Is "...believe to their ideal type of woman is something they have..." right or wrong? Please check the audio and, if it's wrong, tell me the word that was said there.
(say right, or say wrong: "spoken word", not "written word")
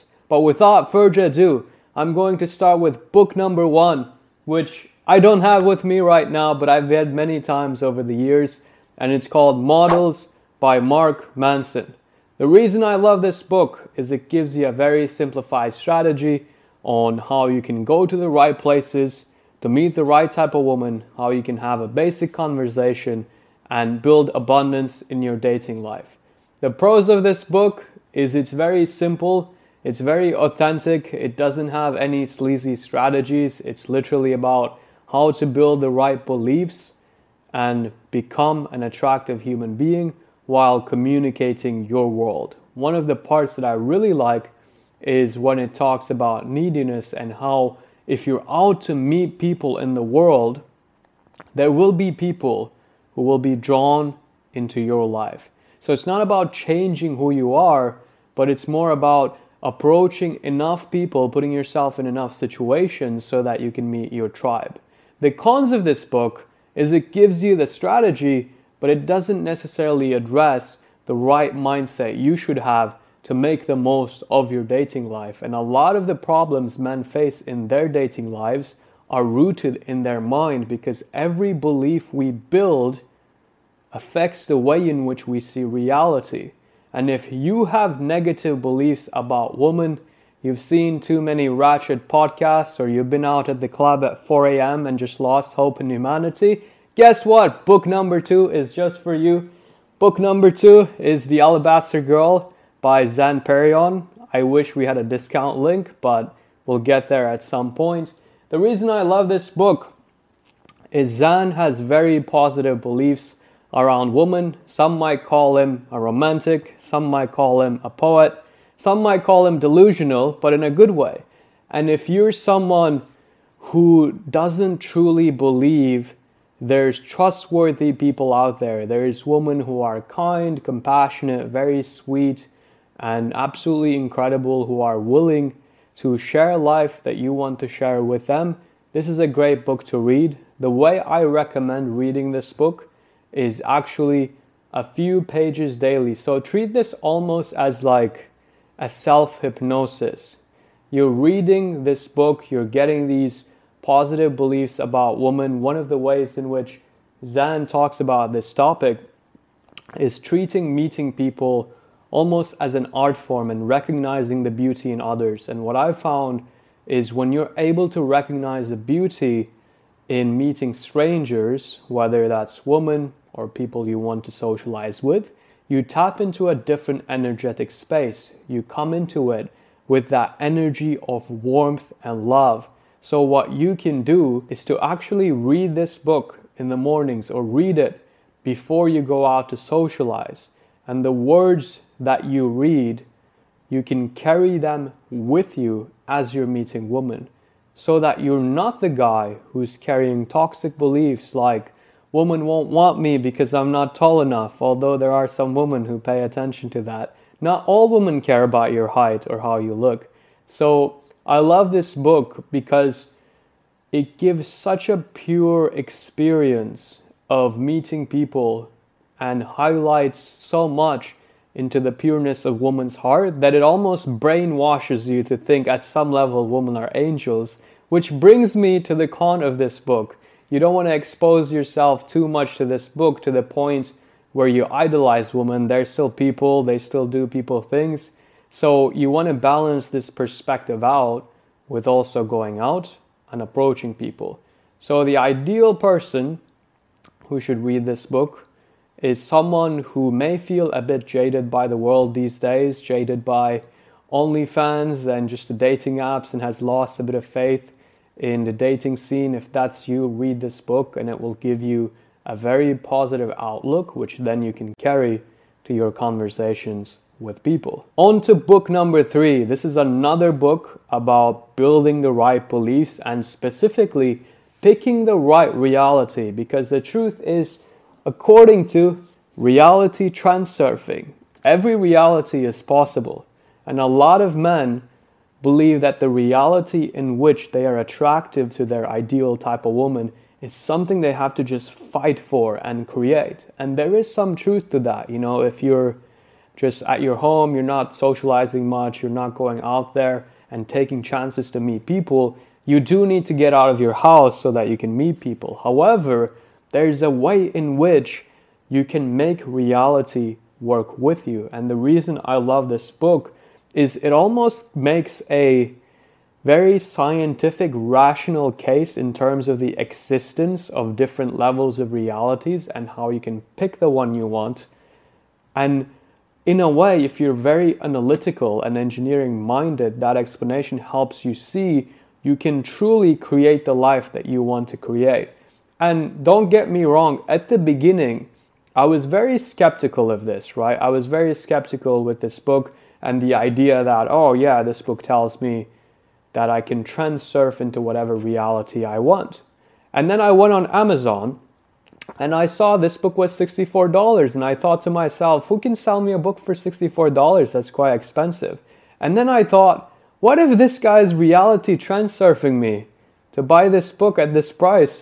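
wrong: "attractive", not "believe".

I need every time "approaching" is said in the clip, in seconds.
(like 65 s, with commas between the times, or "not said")
59 s, 243 s.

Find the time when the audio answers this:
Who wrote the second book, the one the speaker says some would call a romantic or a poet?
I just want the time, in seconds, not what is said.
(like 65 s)
103 s.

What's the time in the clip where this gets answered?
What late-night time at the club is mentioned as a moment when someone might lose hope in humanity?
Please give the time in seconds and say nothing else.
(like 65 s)
94 s.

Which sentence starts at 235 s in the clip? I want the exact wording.
They're still people, they still do people things.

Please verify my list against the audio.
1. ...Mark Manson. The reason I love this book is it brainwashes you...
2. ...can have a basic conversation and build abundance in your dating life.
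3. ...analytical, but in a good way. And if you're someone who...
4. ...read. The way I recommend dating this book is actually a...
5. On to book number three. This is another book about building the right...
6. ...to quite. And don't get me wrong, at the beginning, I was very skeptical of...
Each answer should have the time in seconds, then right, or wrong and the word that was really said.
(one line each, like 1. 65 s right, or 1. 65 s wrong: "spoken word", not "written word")
1. 10 s wrong: "gives", not "brainwashes"
2. 21 s right
3. 119 s wrong: "delusional", not "analytical"
4. 139 s wrong: "reading", not "dating"
5. 267 s right
6. 334 s wrong: "create", not "quite".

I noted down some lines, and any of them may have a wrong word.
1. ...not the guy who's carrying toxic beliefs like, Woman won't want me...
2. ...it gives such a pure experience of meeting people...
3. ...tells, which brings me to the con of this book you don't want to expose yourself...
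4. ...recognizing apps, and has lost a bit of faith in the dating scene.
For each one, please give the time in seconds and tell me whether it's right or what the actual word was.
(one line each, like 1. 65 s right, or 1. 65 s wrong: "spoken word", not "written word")
1. 198 s right
2. 213 s right
3. 226 s wrong: "angels", not "tells"
4. 255 s wrong: "dating", not "recognizing".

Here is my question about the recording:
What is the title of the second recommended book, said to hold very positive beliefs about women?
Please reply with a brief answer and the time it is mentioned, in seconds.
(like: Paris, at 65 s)
The Alabaster Girl, at 101 s.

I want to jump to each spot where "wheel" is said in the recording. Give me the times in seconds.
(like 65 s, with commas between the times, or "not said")
not said.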